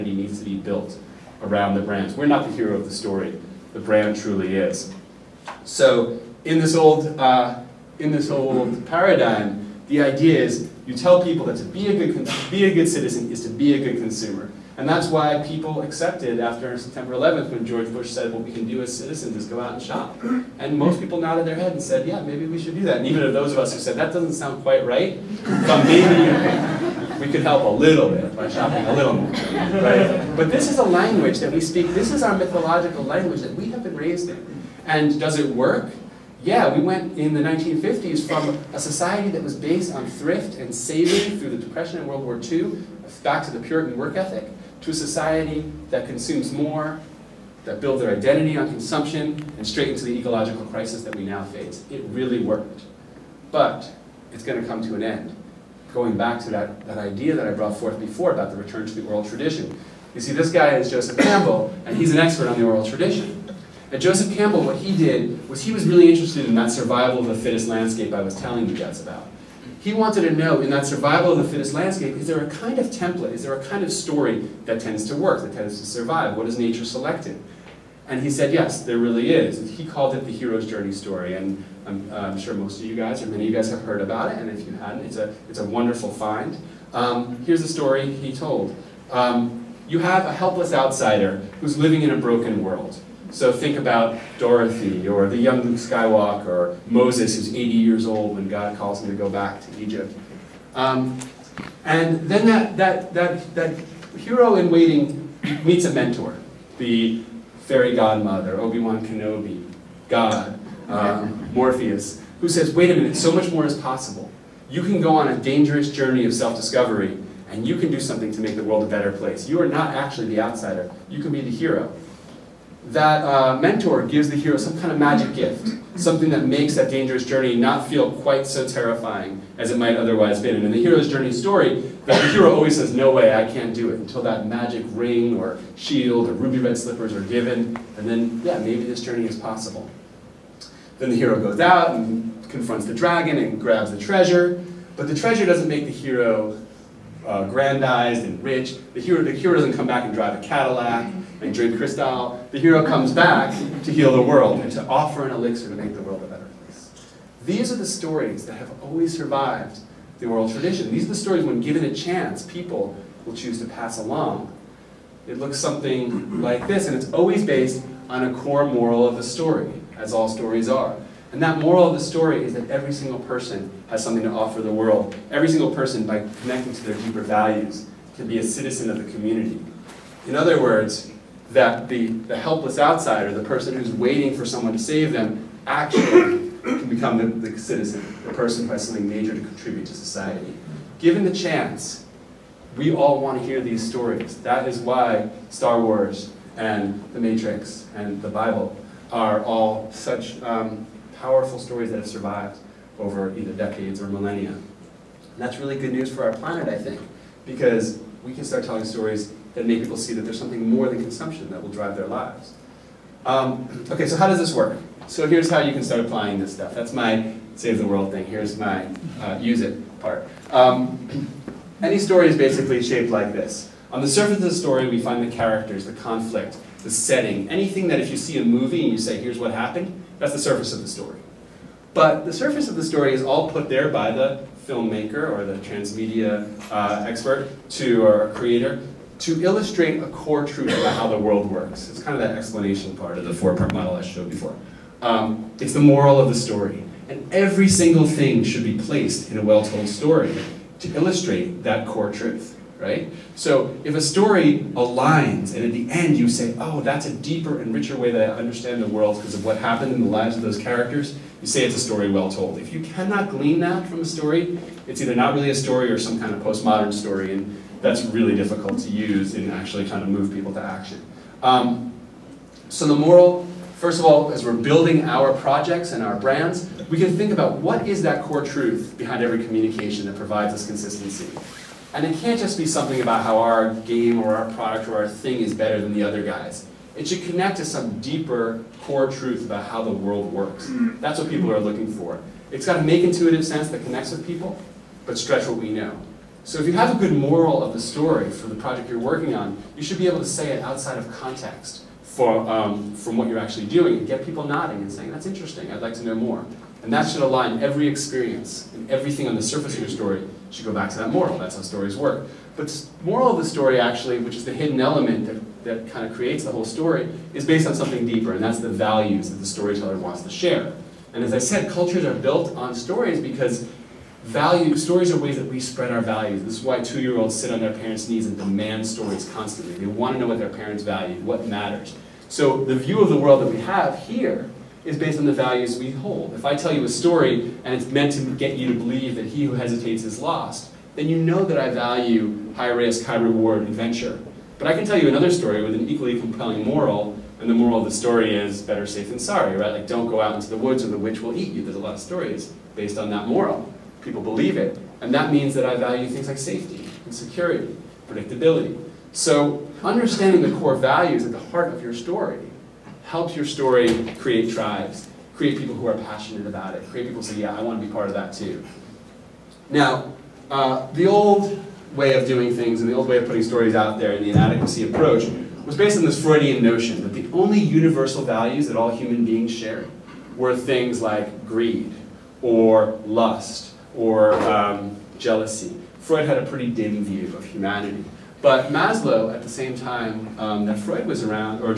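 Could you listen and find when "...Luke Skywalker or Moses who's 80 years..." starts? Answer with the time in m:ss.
1:35.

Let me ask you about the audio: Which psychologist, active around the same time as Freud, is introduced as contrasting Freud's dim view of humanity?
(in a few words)
Maslow.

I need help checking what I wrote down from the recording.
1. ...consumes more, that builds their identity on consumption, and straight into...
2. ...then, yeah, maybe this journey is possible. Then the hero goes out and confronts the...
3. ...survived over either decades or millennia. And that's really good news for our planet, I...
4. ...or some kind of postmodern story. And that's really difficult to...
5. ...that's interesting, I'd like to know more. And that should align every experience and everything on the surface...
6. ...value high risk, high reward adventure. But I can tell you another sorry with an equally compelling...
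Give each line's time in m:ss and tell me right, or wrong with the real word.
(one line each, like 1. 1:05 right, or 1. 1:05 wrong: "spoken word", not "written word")
1. 0:46 right
2. 2:18 right
3. 3:22 right
4. 4:25 right
5. 5:05 right
6. 5:41 wrong: "story", not "sorry".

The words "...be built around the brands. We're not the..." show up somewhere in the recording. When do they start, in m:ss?
0:00.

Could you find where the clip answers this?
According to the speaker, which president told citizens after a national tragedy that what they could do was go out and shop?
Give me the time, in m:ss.
0:17.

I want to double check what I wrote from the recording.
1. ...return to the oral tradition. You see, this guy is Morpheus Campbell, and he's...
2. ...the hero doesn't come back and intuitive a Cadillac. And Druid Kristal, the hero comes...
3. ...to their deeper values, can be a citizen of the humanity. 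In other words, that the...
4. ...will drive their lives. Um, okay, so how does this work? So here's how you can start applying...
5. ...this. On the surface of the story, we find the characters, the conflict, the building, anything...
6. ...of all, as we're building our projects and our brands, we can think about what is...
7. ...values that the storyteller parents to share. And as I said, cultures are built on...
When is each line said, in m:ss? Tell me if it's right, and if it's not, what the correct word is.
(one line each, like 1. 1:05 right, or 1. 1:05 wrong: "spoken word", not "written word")
1. 0:58 wrong: "Joseph", not "Morpheus"
2. 2:29 wrong: "drive", not "intuitive"
3. 2:56 wrong: "community", not "humanity"
4. 3:31 right
5. 3:43 wrong: "setting", not "building"
6. 4:33 right
7. 5:18 wrong: "wants", not "parents".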